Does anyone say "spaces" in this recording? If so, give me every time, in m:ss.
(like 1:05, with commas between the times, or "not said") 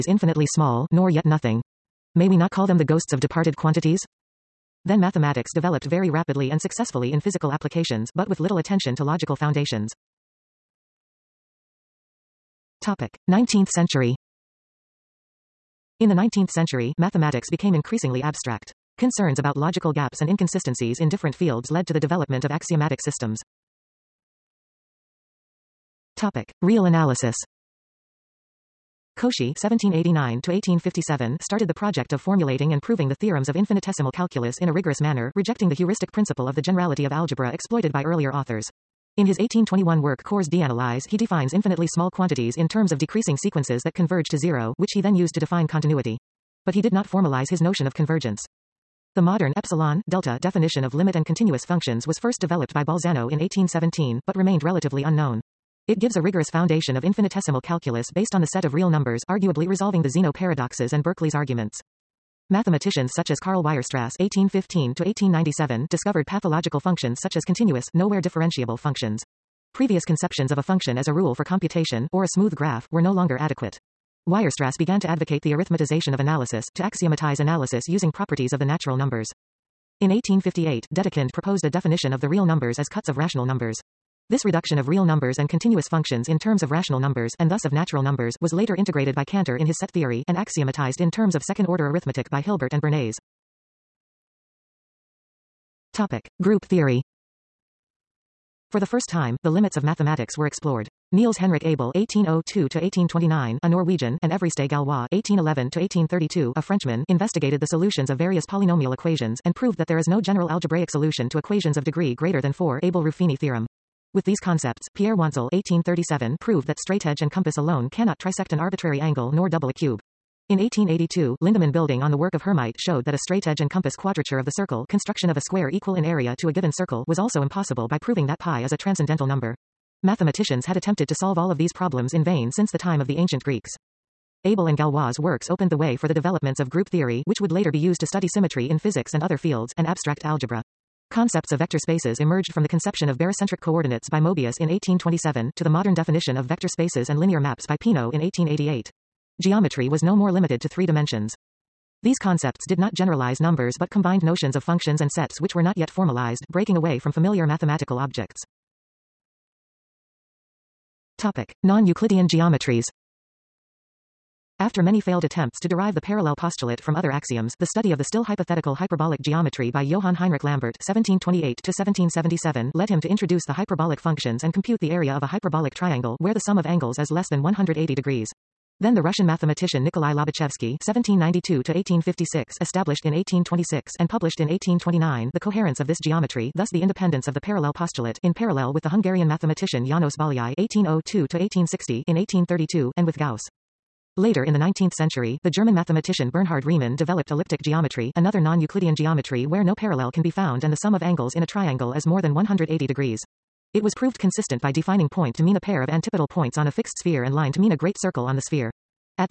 2:21, 2:26.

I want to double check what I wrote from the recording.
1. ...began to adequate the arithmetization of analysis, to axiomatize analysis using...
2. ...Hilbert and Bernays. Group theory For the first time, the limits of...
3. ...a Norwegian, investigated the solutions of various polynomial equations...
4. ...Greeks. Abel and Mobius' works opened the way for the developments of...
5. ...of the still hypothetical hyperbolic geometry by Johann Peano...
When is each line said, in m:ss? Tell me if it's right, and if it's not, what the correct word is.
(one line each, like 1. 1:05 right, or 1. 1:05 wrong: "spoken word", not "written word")
1. 1:14 wrong: "advocate", not "adequate"
2. 1:32 right
3. 1:46 wrong: "Frenchman", not "Norwegian"
4. 2:13 wrong: "Galois", not "Mobius"
5. 2:47 wrong: "Heinrich", not "Peano".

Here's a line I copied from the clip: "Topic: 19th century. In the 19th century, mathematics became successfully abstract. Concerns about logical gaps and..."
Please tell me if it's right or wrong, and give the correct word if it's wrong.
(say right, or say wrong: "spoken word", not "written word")
wrong: "increasingly", not "successfully".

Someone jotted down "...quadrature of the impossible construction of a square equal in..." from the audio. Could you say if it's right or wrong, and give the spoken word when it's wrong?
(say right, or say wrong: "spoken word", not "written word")
wrong: "circle", not "impossible".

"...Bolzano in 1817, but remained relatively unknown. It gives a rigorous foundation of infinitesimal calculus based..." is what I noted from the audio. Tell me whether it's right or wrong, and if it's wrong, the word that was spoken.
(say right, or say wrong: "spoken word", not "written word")
right.